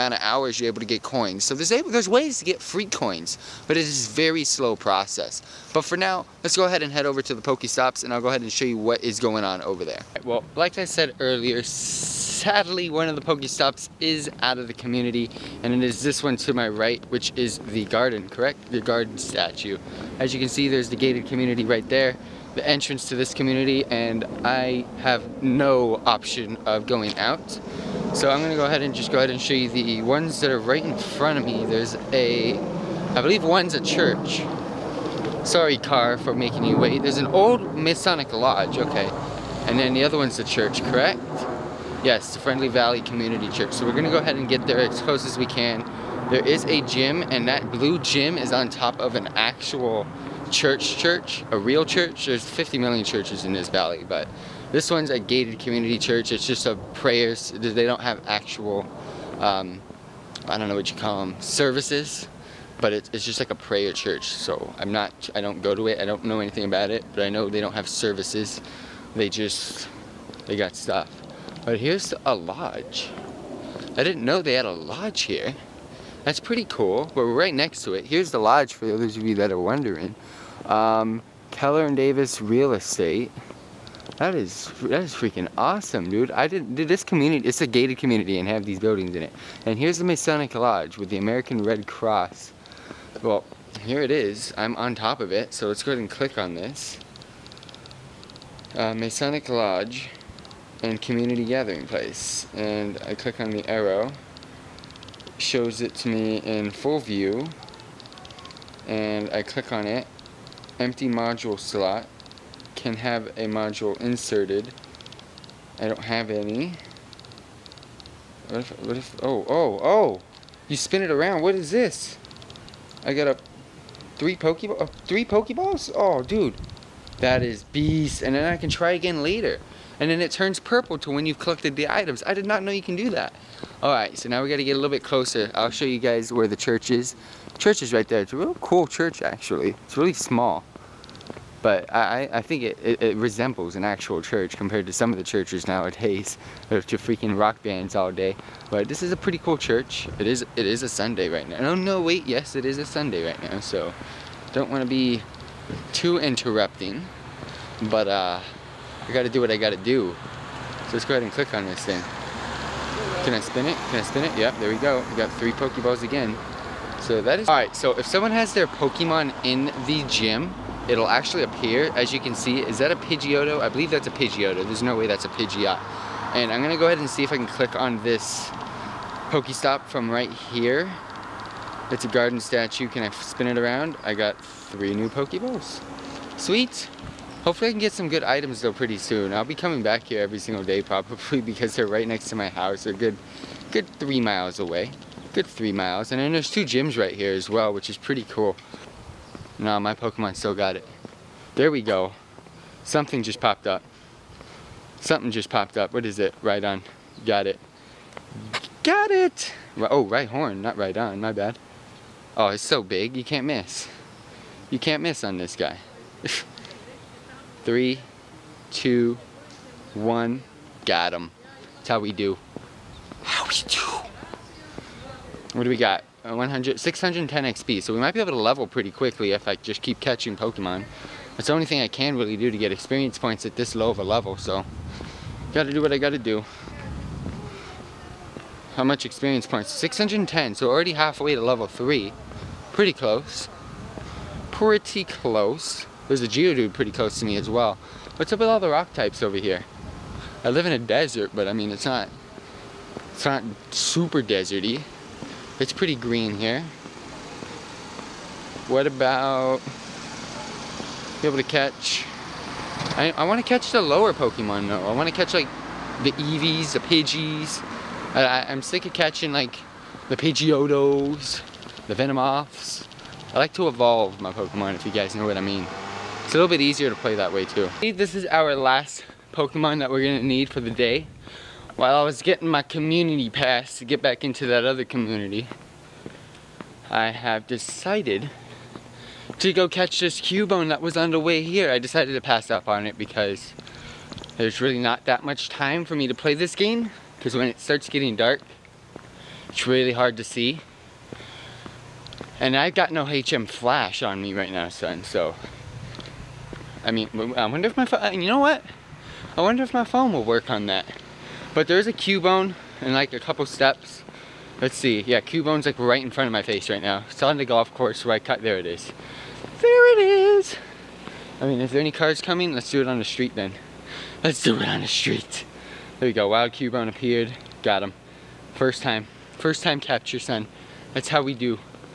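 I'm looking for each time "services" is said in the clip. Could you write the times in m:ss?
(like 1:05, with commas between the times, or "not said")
1:01, 1:07.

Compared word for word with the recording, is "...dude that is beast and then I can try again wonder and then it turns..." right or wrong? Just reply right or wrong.
wrong.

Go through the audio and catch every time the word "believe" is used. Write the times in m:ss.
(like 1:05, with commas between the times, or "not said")
0:33, 2:53.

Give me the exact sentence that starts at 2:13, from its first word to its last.
All right, so now we gotta get a little bit closer.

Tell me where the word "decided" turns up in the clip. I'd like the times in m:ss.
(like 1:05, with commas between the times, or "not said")
4:47, 4:51.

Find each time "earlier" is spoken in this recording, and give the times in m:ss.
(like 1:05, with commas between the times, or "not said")
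0:11.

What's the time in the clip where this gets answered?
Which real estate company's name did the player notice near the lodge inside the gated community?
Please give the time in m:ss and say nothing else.
1:21.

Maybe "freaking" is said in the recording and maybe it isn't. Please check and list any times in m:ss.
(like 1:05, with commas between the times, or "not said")
1:25, 2:26.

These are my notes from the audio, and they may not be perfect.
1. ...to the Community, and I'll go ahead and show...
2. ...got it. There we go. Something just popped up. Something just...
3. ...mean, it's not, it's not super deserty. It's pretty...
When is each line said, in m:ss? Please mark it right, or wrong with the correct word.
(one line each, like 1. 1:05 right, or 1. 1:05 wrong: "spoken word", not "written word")
1. 0:07 wrong: "Pokestops", not "Community"
2. 3:20 right
3. 4:11 right.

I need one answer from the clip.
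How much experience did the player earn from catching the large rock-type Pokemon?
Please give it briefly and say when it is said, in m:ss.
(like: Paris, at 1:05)
610 XP, at 3:46.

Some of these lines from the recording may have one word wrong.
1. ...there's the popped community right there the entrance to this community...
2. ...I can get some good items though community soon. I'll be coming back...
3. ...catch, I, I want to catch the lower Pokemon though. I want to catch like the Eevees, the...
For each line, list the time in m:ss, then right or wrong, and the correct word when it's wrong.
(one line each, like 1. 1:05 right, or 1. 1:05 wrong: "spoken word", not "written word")
1. 0:20 wrong: "gated", not "popped"
2. 3:07 wrong: "pretty", not "community"
3. 4:21 right.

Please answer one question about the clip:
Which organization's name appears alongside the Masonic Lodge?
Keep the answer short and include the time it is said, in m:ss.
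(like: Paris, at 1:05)
American Red Cross, at 1:31.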